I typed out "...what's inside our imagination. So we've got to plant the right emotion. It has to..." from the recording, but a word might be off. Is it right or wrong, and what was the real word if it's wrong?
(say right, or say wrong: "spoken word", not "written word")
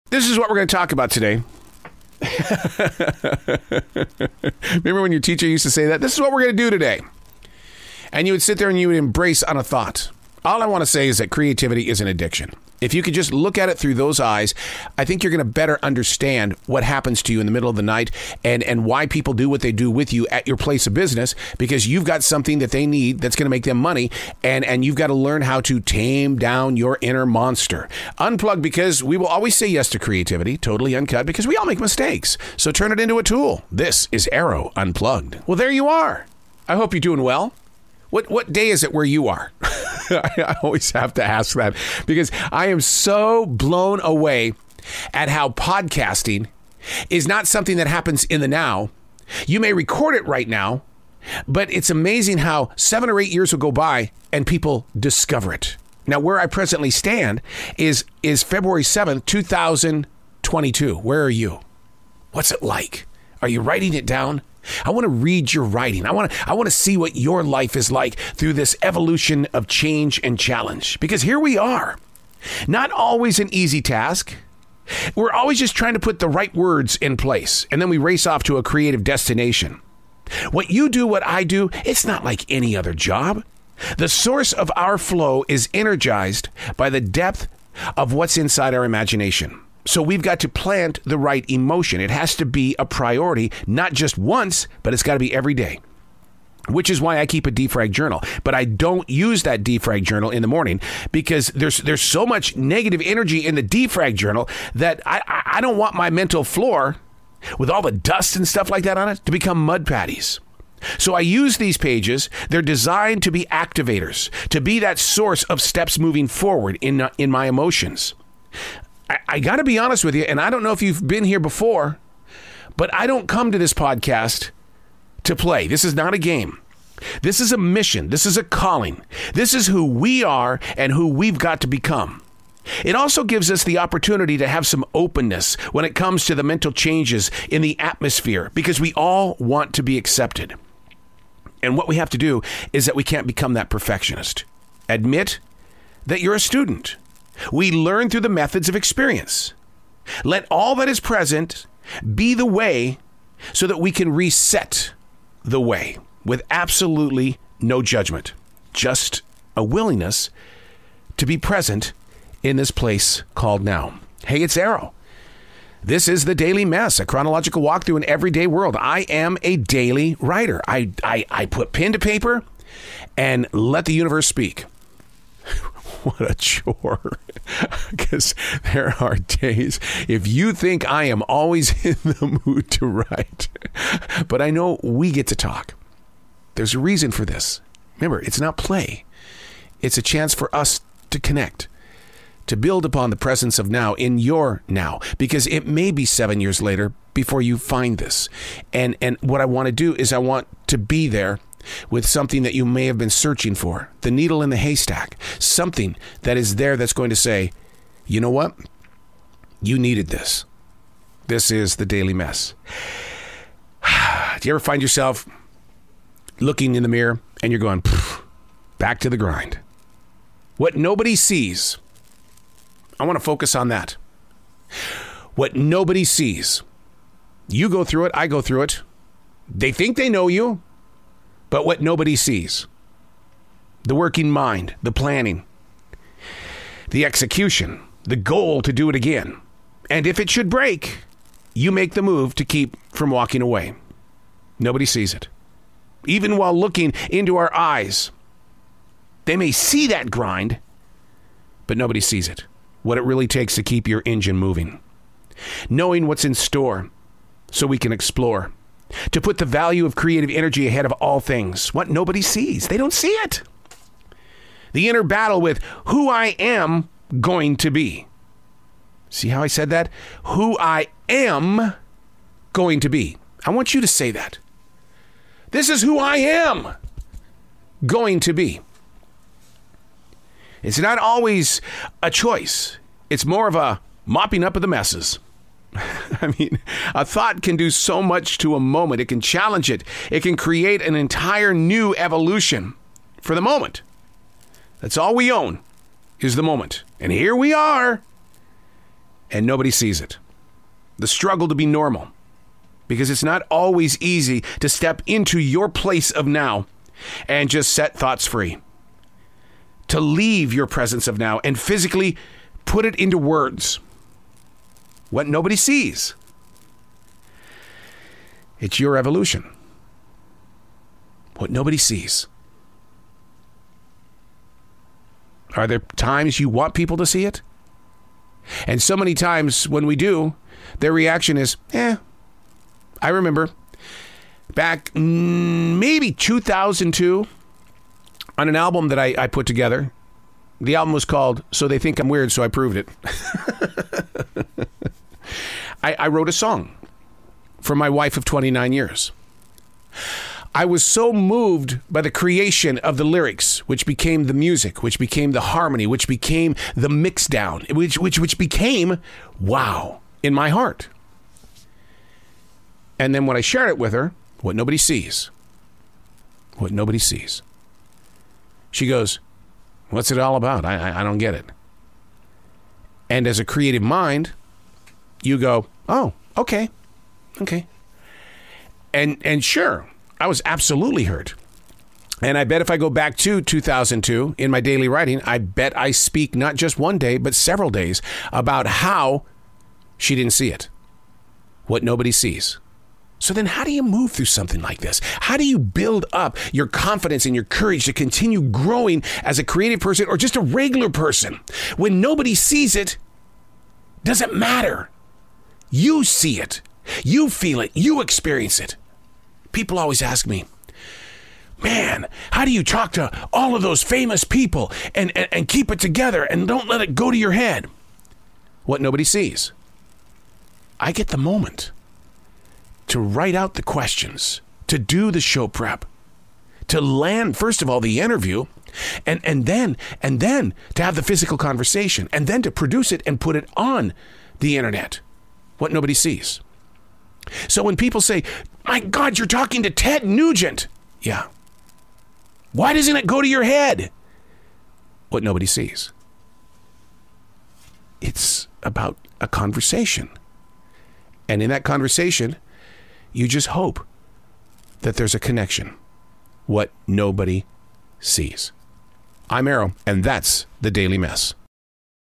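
right.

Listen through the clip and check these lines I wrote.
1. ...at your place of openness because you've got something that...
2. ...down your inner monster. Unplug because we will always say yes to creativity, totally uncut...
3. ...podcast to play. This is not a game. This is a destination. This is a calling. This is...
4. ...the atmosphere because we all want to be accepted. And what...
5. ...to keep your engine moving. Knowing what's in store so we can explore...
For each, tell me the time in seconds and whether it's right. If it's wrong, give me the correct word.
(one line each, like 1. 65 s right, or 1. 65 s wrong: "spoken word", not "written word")
1. 20 s wrong: "business", not "openness"
2. 26 s right
3. 123 s wrong: "mission", not "destination"
4. 137 s right
5. 253 s right.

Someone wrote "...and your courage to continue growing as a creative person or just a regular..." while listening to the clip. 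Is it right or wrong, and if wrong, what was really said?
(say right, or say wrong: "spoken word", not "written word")
right.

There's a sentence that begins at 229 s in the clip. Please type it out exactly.
They think they know you, but what nobody sees the working mind, the planning, the execution, the goal to do it again.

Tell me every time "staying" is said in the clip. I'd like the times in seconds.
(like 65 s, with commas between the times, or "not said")
not said.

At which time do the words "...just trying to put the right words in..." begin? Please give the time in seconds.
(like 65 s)
75 s.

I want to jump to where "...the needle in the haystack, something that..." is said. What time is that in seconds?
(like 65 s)
204 s.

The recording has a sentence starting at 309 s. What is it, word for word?
To leave your presence of now and physically put it into words what nobody sees.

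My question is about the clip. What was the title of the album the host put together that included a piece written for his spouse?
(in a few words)
So They Think I'm Weird, so I proved it.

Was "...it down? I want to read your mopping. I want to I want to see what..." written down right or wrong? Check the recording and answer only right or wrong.
wrong.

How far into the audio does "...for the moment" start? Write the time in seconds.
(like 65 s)
293 s.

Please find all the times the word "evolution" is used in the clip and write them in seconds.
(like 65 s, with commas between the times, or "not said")
68 s, 291 s, 318 s.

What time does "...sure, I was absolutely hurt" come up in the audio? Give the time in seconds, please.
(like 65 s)
379 s.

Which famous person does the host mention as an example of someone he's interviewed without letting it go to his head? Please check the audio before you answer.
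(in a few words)
Ted Nugent.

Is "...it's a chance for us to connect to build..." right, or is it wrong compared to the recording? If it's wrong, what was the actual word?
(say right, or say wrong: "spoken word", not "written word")
right.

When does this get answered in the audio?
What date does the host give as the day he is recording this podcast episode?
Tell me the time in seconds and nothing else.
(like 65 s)
58 s.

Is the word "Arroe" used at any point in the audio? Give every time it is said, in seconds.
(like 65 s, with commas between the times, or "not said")
34 s, 164 s, 459 s.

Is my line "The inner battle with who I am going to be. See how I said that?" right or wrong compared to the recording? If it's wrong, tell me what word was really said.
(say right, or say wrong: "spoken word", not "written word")
right.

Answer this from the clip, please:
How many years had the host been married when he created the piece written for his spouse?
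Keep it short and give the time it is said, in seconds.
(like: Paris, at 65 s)
29, at 348 s.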